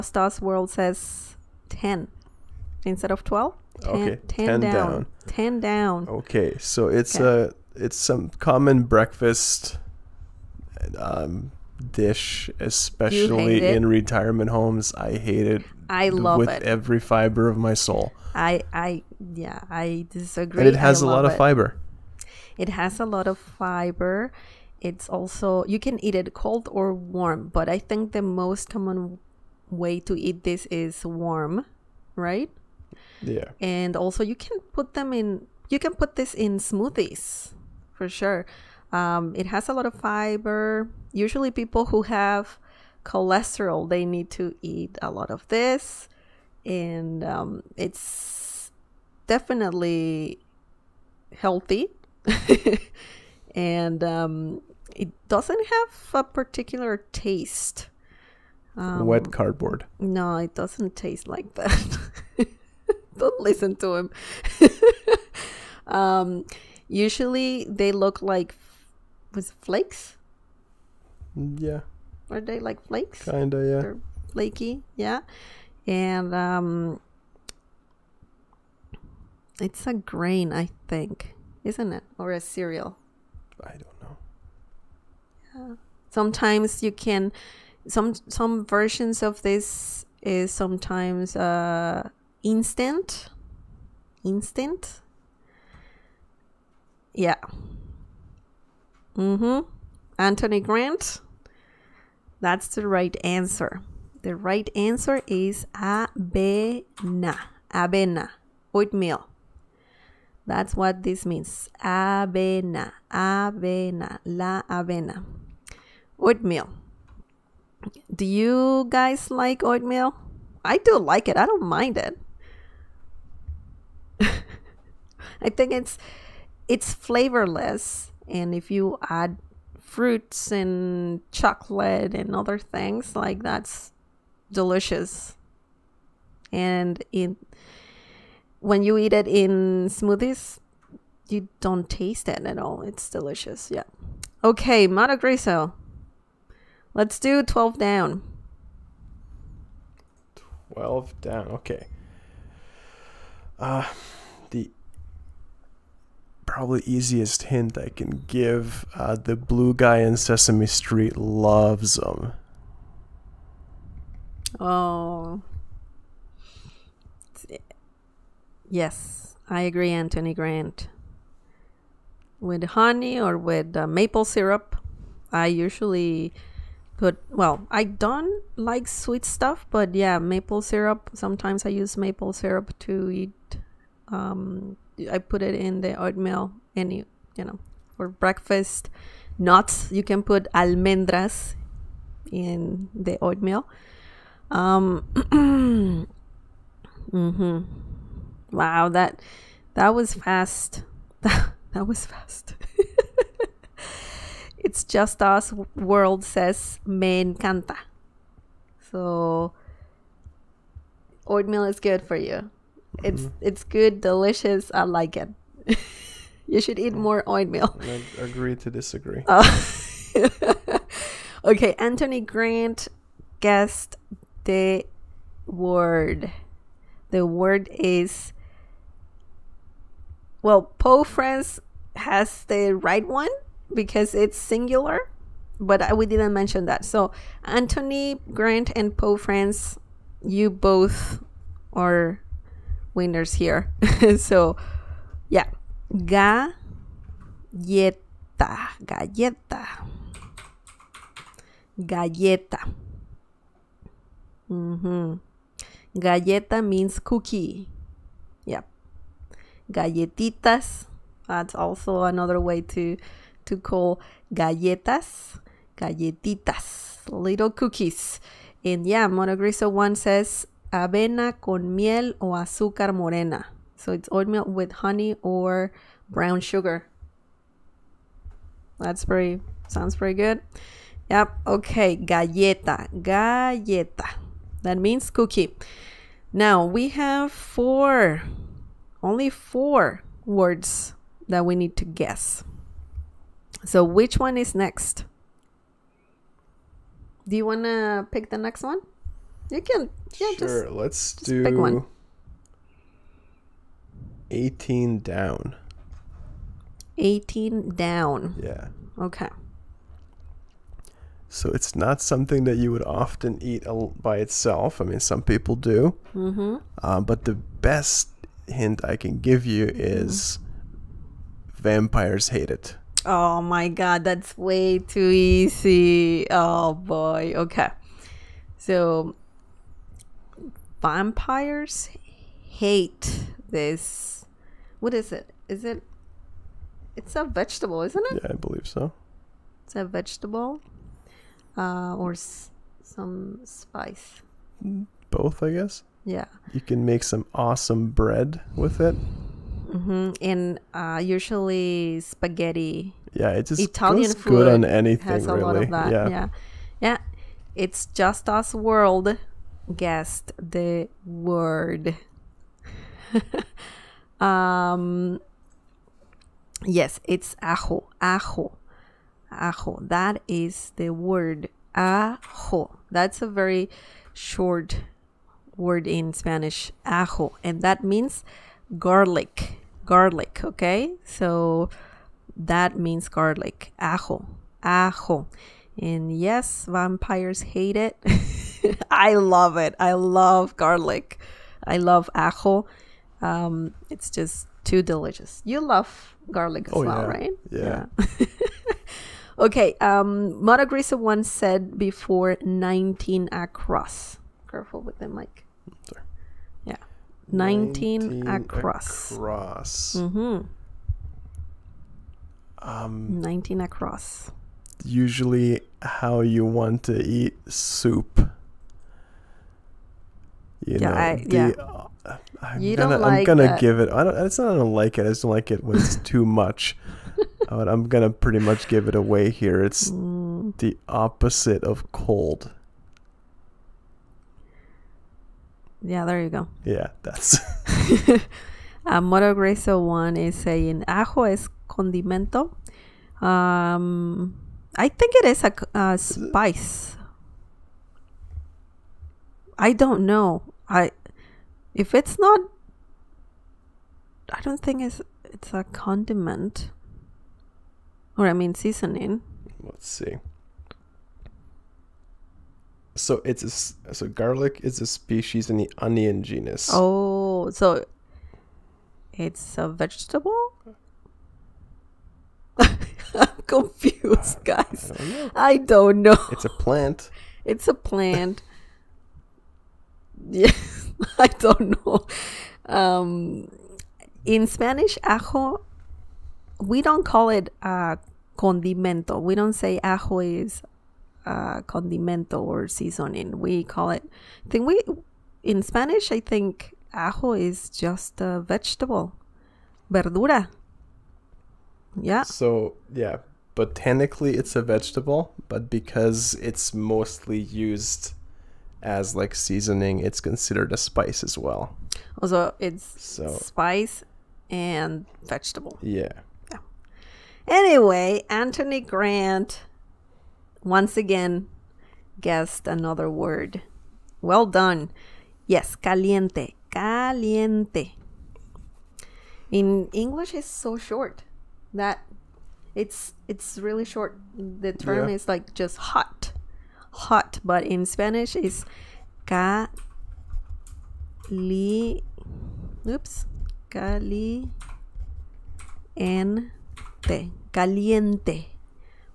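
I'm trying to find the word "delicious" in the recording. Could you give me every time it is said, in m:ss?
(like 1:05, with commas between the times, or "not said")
2:14, 2:23, 3:34, 6:34.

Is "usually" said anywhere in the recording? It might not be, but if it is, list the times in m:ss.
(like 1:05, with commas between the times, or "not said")
0:41, 1:06, 2:55, 5:51, 6:54.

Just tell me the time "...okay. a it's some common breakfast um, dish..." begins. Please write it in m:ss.
0:07.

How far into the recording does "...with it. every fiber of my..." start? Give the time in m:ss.
0:16.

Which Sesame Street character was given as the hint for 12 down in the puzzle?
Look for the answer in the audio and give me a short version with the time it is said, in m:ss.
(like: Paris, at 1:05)
the blue guy, at 2:39.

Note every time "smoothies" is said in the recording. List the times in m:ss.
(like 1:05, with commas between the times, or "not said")
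0:36, 2:19.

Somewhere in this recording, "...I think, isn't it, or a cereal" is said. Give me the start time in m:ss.
1:20.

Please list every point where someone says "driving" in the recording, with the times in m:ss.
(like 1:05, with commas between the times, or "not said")
not said.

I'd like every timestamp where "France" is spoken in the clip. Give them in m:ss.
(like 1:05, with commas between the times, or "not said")
3:51, 3:59.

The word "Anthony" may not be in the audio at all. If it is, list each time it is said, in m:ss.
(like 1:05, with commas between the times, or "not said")
1:40, 2:49, 3:41, 3:57, 8:38.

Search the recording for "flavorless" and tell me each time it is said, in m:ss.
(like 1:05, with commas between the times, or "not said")
2:06.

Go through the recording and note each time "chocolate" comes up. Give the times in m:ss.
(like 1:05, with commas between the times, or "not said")
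2:11.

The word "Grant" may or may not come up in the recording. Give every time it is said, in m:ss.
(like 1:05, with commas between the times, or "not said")
1:40, 2:50, 3:42, 3:58, 8:38.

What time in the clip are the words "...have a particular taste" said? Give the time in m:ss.
0:55.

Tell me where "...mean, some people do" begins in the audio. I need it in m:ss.
5:14.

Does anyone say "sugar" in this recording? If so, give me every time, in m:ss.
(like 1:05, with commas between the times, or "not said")
4:36.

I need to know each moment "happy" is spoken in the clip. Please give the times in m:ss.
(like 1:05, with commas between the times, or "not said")
not said.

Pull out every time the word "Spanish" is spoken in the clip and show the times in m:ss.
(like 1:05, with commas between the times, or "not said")
6:16, 8:04, 8:15, 8:57.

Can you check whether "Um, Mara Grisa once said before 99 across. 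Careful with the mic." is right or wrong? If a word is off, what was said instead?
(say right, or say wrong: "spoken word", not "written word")
wrong: "19", not "99".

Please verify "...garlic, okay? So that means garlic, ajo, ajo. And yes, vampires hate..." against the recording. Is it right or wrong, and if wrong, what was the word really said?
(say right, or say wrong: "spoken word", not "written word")
right.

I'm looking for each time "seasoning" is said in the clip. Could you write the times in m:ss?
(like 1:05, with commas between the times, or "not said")
7:38, 8:12, 8:29.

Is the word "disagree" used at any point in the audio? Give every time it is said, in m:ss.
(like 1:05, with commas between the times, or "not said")
0:20, 3:38.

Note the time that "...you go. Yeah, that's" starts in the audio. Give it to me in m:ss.
7:16.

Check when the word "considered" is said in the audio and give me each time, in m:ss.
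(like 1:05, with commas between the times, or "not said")
8:30.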